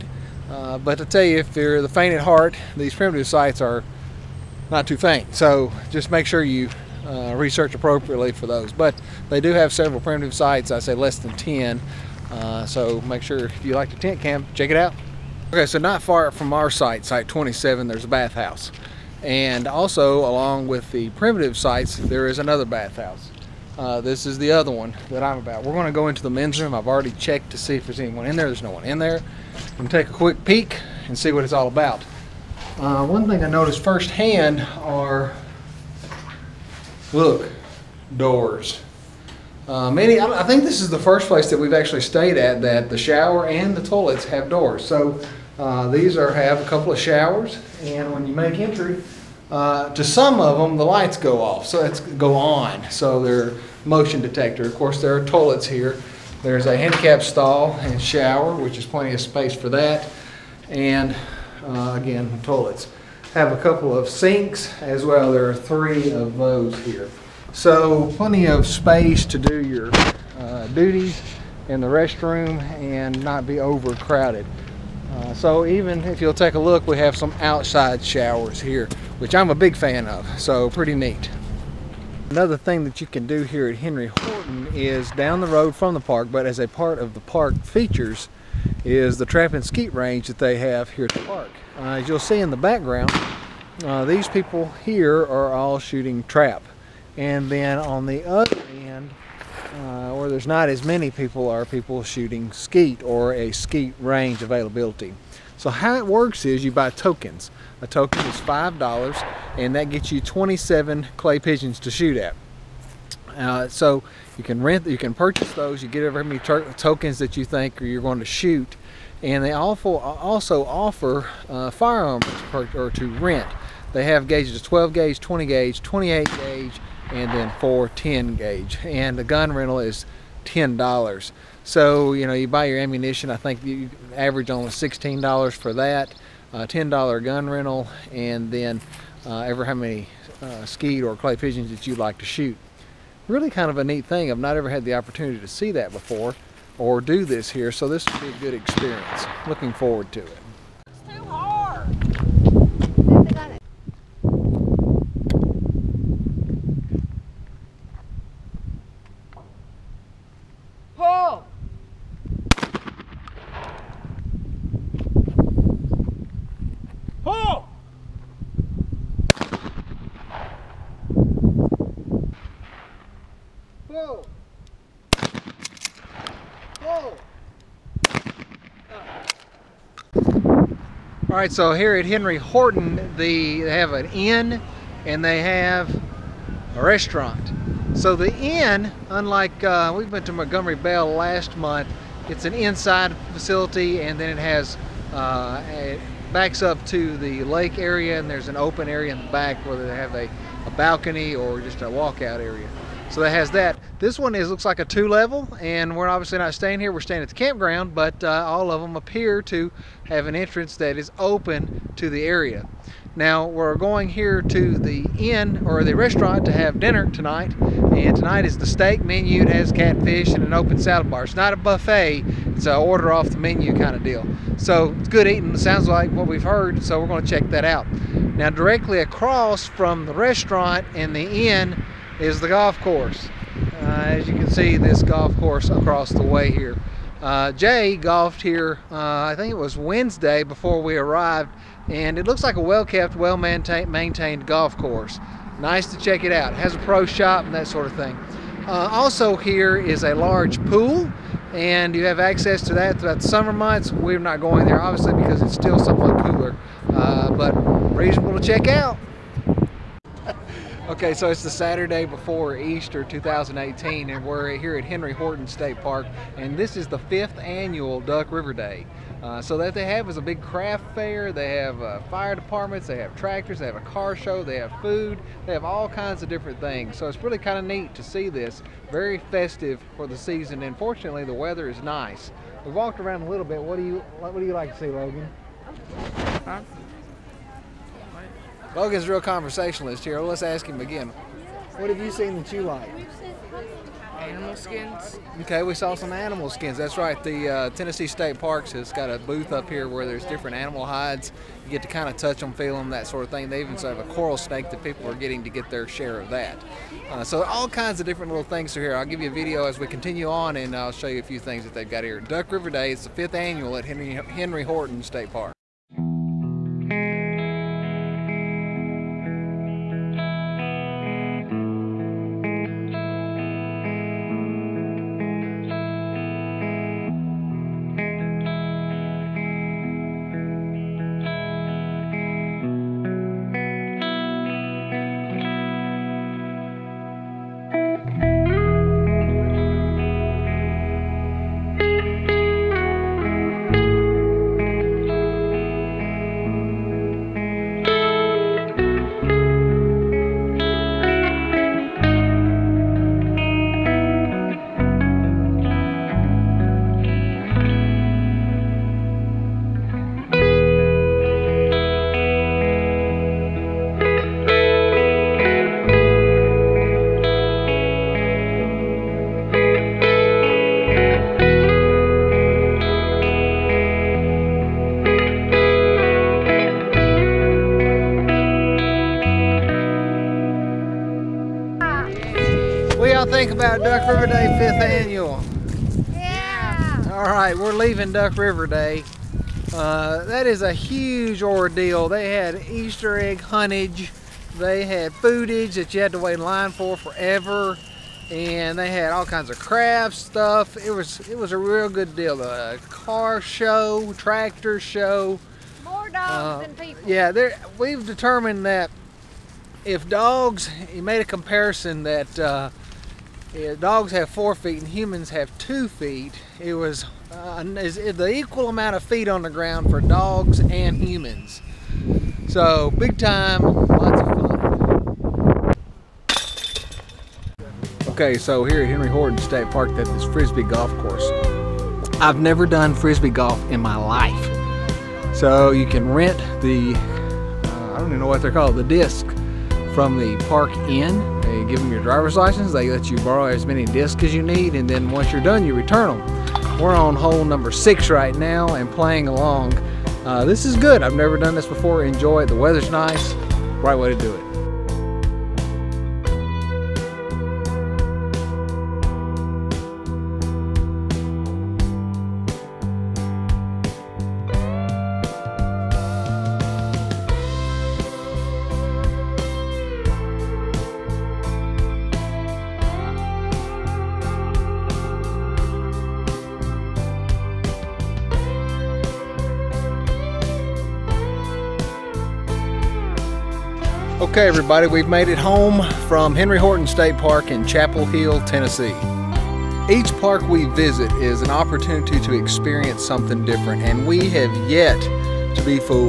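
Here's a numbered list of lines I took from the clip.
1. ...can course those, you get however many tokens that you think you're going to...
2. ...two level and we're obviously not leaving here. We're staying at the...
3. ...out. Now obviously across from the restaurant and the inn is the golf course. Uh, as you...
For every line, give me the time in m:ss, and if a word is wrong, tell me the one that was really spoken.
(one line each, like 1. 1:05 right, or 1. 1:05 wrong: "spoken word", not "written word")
1. 1:54 wrong: "purchase", not "course"
2. 3:24 wrong: "staying", not "leaving"
3. 3:47 wrong: "directly", not "obviously".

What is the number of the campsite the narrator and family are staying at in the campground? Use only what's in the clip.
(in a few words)
27.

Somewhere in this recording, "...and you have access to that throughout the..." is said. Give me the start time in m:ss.
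4:11.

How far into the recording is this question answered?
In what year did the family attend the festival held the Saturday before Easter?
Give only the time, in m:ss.
4:23.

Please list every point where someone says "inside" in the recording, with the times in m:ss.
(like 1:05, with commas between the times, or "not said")
3:12.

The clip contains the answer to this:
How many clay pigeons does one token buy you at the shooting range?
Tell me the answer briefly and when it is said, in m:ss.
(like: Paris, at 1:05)
27, at 1:50.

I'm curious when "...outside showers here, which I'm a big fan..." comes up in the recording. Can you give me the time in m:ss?
1:17.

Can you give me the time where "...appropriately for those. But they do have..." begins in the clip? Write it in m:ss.
0:07.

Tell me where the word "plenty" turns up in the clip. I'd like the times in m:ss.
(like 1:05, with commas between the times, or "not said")
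0:58, 1:08.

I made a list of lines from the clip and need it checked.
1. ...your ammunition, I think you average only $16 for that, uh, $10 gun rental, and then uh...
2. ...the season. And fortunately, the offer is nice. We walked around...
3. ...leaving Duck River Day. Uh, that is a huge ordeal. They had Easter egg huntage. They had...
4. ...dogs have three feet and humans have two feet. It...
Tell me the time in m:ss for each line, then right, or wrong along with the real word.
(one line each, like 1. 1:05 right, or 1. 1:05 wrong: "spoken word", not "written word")
1. 2:12 right
2. 4:40 wrong: "weather", not "offer"
3. 6:27 right
4. 6:53 wrong: "four", not "three".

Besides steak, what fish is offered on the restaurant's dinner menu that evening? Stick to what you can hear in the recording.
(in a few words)
Catfish.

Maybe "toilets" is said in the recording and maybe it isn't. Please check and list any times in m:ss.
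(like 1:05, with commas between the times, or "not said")
0:43, 0:55, 1:02.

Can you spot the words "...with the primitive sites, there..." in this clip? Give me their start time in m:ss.
0:20.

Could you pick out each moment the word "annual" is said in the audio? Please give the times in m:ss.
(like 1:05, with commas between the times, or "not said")
4:27, 5:13, 6:25.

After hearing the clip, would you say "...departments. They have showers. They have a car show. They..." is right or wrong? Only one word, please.
wrong.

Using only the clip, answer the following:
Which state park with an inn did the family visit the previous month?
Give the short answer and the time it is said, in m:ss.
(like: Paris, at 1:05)
Montgomery Bell, at 3:10.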